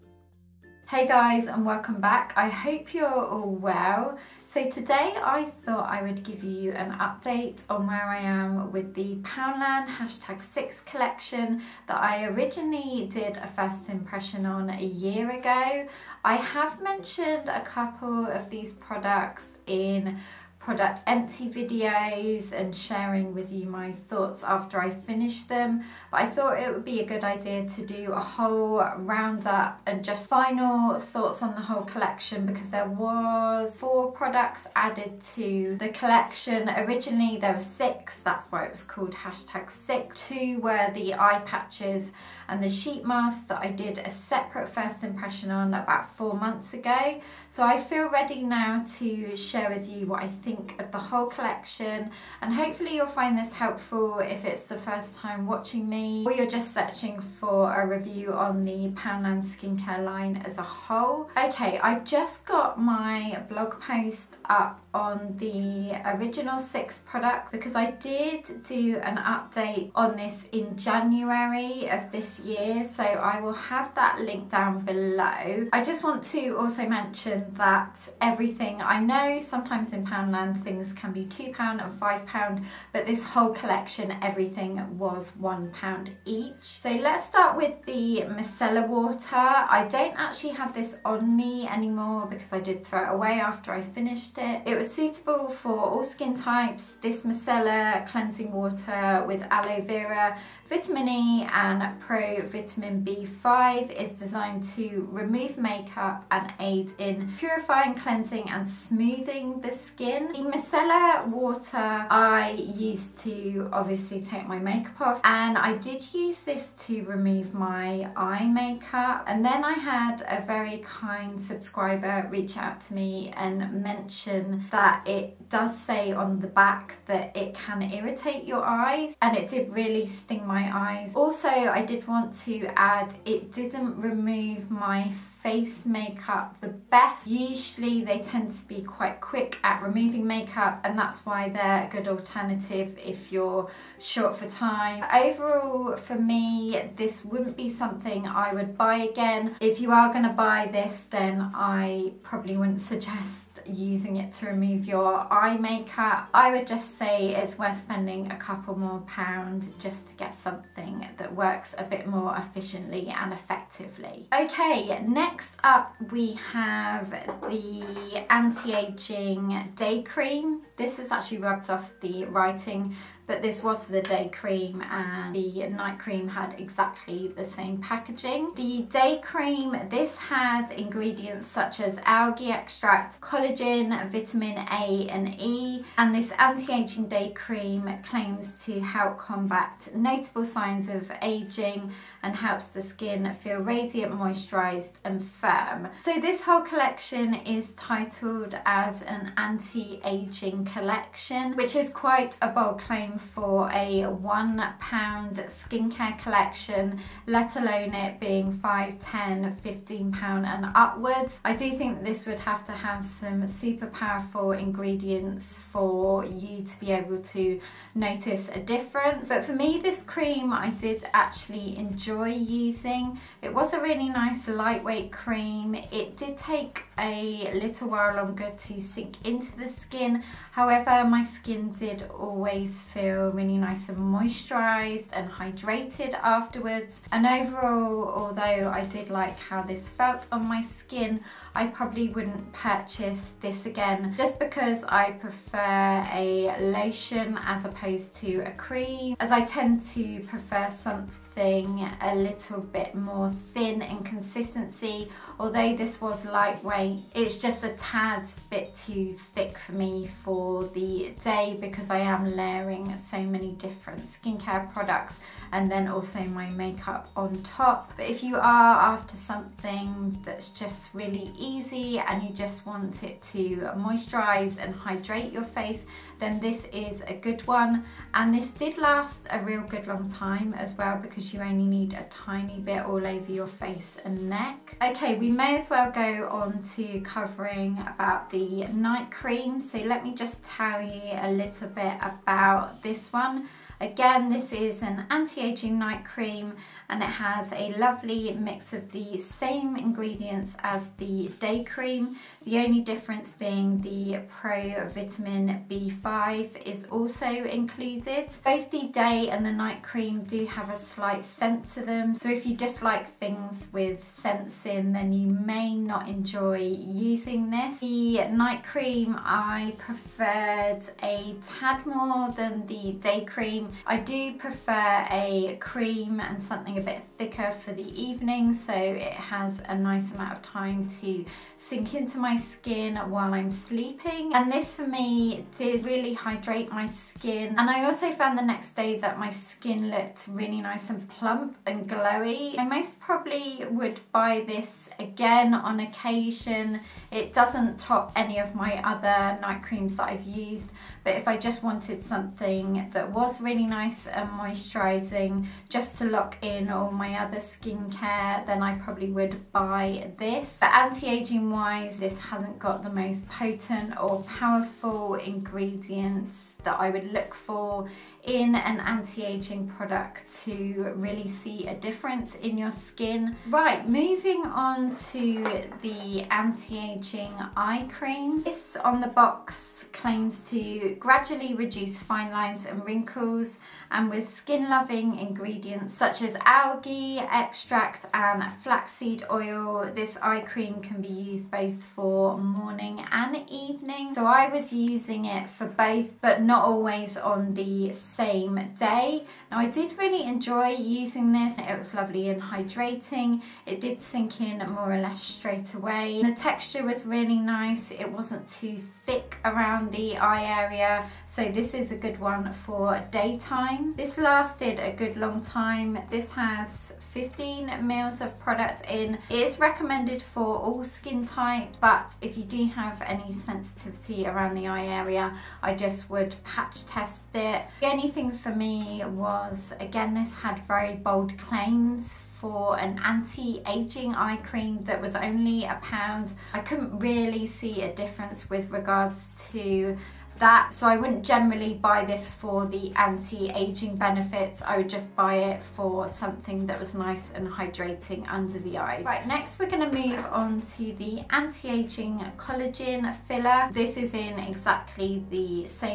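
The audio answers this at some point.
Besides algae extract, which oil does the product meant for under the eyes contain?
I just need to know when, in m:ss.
6:28.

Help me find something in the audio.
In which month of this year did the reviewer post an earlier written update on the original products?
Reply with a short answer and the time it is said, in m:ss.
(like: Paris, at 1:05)
January, at 1:10.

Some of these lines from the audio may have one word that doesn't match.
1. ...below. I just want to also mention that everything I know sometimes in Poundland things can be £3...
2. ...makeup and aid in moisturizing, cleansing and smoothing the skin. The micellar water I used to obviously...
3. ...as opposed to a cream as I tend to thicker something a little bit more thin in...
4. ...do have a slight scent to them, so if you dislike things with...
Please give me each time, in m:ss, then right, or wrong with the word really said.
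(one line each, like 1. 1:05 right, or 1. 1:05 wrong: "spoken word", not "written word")
1. 1:14 wrong: "2", not "3"
2. 1:45 wrong: "purifying", not "moisturizing"
3. 4:07 wrong: "prefer", not "thicker"
4. 5:10 right.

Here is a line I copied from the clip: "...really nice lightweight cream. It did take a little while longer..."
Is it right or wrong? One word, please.
right.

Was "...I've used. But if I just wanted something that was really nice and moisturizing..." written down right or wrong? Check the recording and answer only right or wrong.
right.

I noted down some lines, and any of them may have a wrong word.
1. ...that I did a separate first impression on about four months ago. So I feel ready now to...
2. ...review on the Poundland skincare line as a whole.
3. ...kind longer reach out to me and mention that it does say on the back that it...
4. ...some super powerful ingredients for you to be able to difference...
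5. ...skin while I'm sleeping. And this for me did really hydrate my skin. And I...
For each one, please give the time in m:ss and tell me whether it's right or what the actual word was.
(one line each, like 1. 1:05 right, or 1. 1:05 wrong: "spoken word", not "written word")
1. 0:43 right
2. 0:57 right
3. 2:00 wrong: "subscriber", not "longer"
4. 3:33 wrong: "notice", not "difference"
5. 5:32 right.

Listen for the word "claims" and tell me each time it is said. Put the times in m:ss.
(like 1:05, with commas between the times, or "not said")
3:08, 3:22, 6:19, 7:11.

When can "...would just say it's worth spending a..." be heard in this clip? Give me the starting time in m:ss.
2:36.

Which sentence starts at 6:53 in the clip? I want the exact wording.
This lasted a good long time, this has 15 mils of product in.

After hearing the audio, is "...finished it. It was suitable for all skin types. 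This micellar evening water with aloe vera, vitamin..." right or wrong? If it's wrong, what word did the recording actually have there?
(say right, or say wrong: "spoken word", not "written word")
wrong: "cleansing", not "evening".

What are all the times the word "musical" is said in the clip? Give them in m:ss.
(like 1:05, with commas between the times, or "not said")
not said.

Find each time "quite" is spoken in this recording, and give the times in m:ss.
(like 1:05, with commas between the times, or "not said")
2:18, 3:21.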